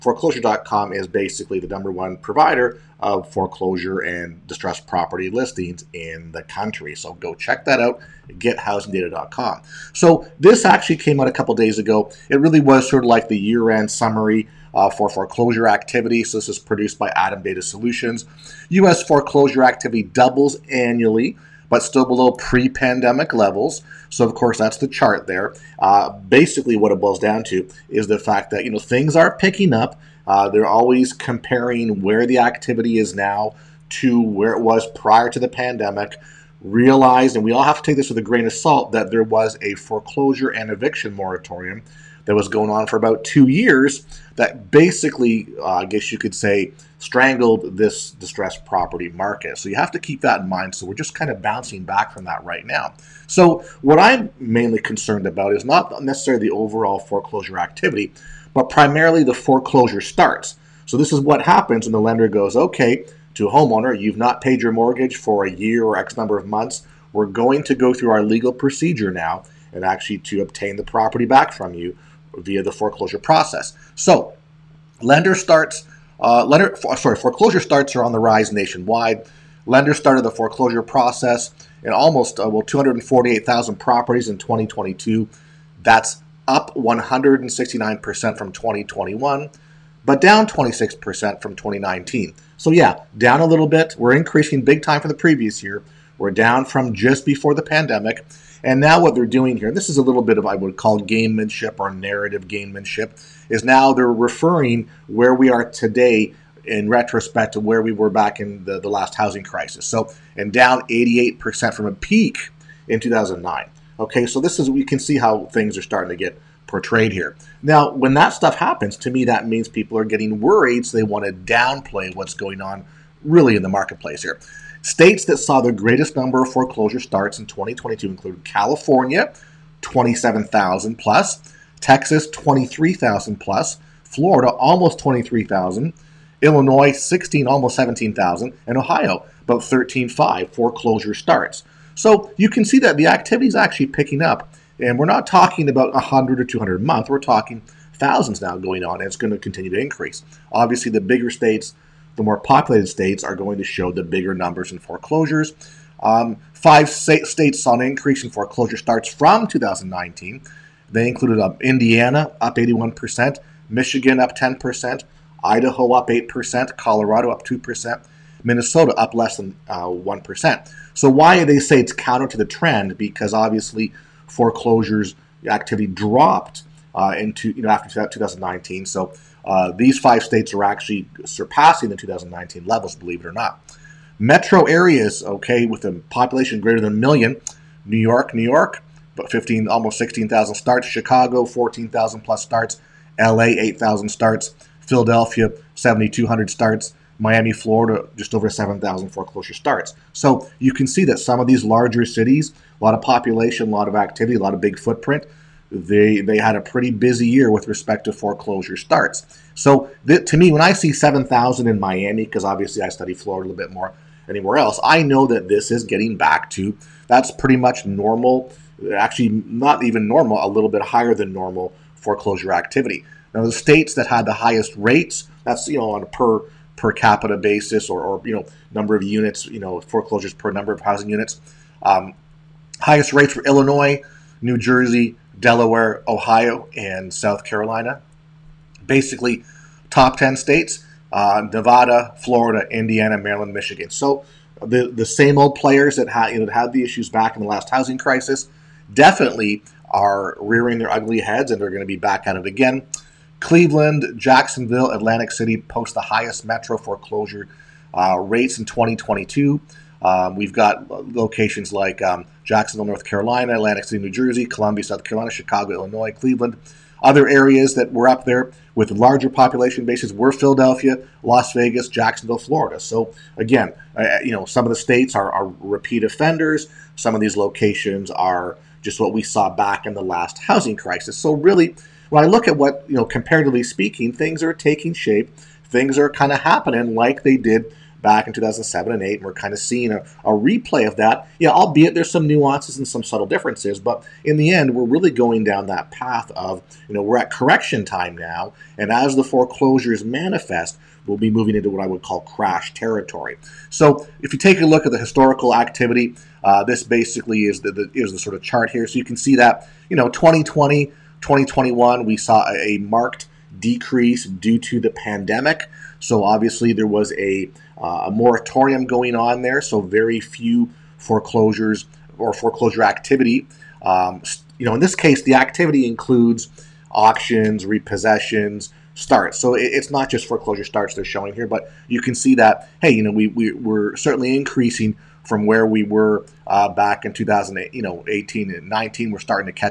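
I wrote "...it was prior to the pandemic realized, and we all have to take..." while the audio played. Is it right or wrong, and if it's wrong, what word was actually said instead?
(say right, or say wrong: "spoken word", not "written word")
right.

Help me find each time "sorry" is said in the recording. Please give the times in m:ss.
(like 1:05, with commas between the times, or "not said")
1:16.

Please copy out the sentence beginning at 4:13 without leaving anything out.
Cleveland, Jacksonville, Atlantic City post the highest metro foreclosure uh, rates in 2022.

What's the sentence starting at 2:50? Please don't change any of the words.
So, why do they say it's counter to the trend?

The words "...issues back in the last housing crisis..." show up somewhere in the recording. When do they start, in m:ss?
4:06.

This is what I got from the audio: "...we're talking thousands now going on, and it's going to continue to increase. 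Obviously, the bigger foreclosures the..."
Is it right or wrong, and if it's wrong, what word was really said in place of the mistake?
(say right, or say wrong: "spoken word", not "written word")
wrong: "states", not "foreclosures".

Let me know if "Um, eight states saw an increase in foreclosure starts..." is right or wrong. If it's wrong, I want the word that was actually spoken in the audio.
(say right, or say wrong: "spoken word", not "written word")
wrong: "five", not "eight".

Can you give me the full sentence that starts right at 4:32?
So again, uh, uh, you know, some of the states are, are repeat offenders.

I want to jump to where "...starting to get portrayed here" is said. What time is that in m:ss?
1:55.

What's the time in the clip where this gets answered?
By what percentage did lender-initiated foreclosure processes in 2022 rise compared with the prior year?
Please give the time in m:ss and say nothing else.
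1:26.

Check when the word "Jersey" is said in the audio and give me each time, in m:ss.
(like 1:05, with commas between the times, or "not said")
3:54, 4:24.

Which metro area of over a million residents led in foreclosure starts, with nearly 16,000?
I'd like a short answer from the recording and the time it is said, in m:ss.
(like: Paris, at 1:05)
New York, at 3:07.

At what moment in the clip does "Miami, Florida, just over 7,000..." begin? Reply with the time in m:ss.
3:17.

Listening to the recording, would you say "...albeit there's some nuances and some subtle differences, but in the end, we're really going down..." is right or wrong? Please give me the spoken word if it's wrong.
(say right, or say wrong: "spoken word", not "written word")
right.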